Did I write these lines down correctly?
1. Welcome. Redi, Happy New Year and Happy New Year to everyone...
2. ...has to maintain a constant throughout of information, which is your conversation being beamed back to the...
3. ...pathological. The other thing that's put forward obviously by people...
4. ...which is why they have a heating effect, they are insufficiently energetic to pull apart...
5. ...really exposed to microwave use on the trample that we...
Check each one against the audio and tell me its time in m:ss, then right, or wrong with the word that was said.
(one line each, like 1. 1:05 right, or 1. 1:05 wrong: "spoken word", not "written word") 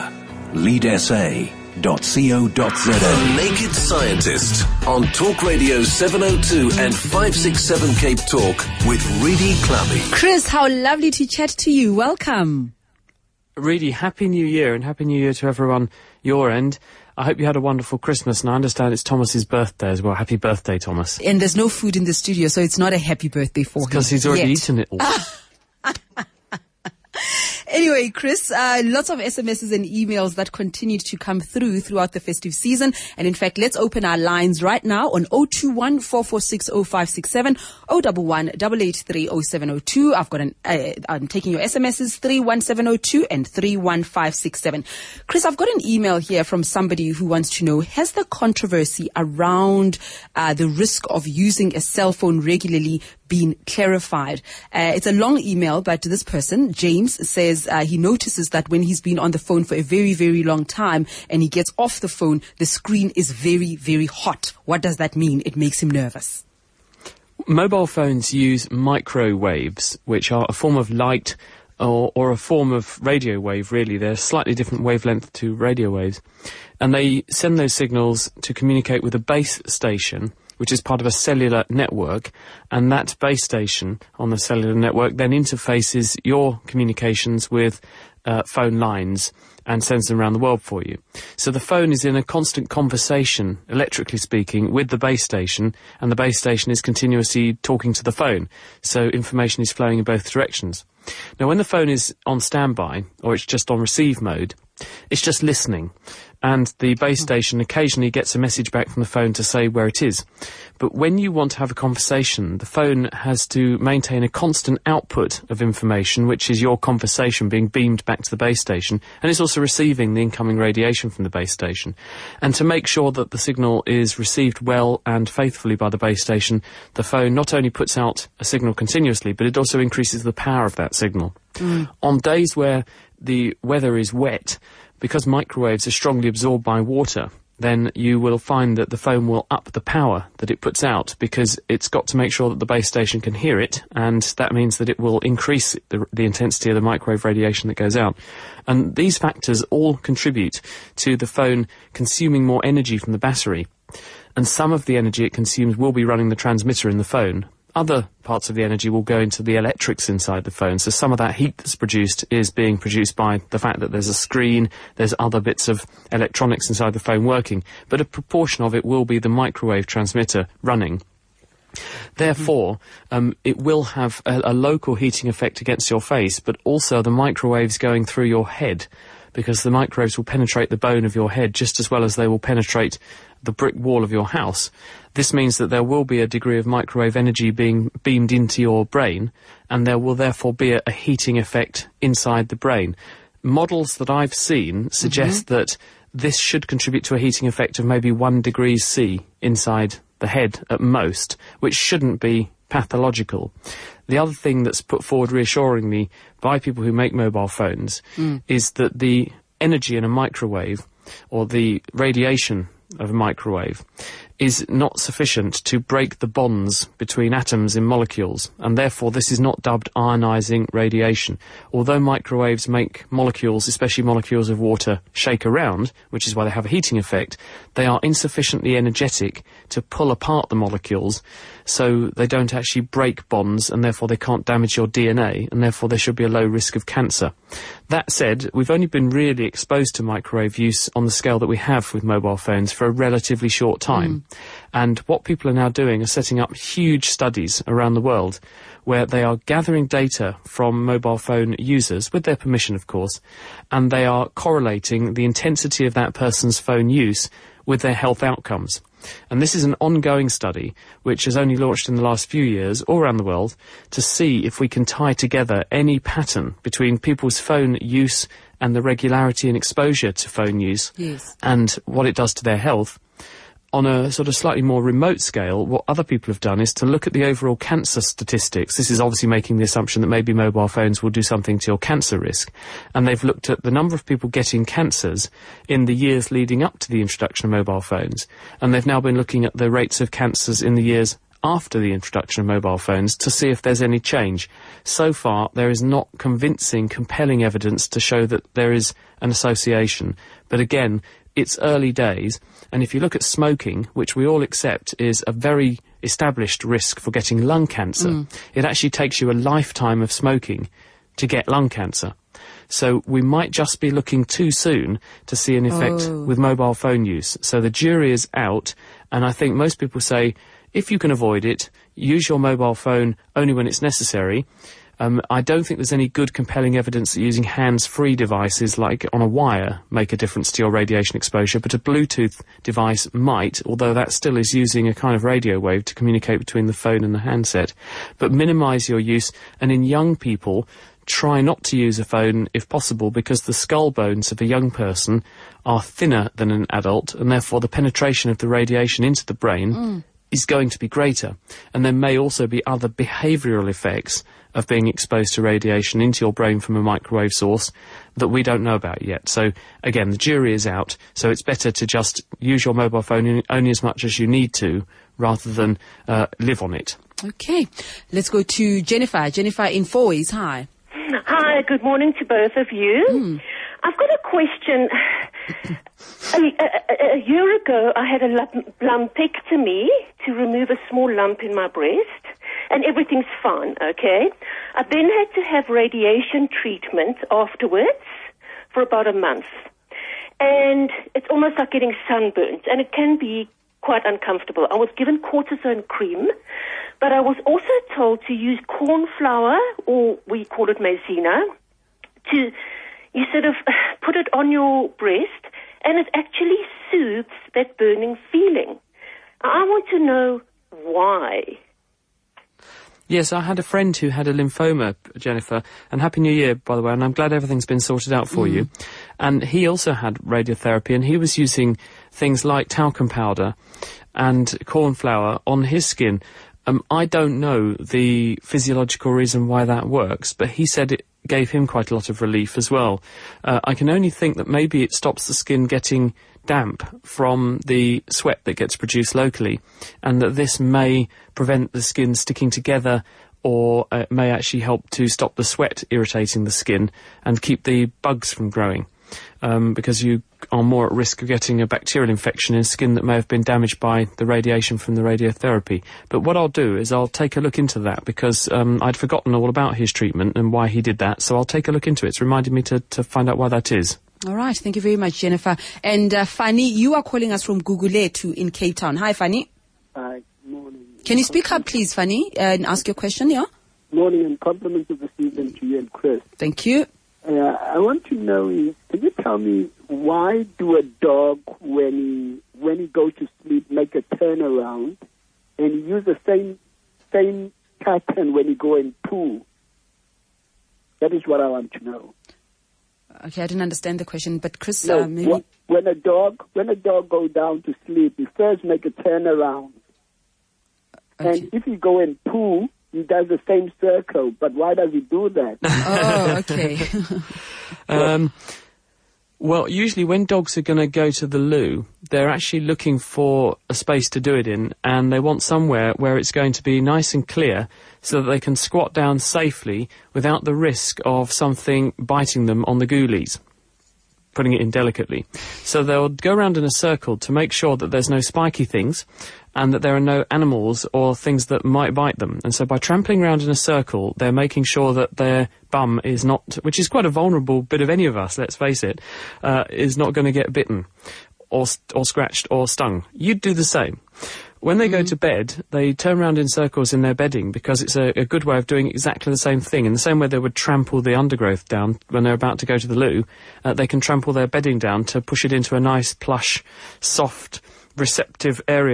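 1. 0:11 right
2. 1:53 wrong: "output", not "throughout"
3. 3:22 wrong: "reassuringly", not "obviously"
4. 3:46 right
5. 3:59 wrong: "scale", not "trample".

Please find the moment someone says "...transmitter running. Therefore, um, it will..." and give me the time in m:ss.
2:49.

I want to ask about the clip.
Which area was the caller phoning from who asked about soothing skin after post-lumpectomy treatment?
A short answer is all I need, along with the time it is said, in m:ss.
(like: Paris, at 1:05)
Fourways, at 6:09.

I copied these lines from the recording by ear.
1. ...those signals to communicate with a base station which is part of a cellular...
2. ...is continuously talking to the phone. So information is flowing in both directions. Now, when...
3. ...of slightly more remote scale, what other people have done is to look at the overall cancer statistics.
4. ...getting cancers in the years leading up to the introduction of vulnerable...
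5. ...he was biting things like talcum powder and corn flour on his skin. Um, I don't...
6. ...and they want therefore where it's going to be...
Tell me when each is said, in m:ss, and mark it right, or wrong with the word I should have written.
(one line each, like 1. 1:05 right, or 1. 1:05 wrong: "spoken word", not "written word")
1. 1:17 right
2. 1:36 right
3. 4:34 right
4. 4:44 wrong: "mobile", not "vulnerable"
5. 7:01 wrong: "using", not "biting"
6. 8:34 wrong: "somewhere", not "therefore".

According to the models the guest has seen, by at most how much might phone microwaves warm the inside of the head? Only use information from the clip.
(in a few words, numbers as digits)
1 degree C.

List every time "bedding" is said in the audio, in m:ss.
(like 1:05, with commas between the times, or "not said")
9:07, 9:14.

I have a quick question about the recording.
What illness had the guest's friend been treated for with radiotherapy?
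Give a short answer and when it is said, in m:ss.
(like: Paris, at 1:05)
lymphoma, at 6:54.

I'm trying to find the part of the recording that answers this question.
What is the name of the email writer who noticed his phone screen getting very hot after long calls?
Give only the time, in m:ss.
0:56.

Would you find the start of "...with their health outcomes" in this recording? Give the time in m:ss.
4:17.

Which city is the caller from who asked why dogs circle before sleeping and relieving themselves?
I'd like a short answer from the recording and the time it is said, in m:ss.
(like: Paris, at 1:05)
Cape Town, at 7:48.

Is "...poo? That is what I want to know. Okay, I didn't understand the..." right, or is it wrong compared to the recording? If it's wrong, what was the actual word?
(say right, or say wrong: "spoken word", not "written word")
right.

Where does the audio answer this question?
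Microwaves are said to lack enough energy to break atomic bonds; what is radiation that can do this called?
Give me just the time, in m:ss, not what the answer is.
3:39.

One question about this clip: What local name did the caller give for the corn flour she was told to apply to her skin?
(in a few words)
maizena.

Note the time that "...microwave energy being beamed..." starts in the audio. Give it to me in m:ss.
3:06.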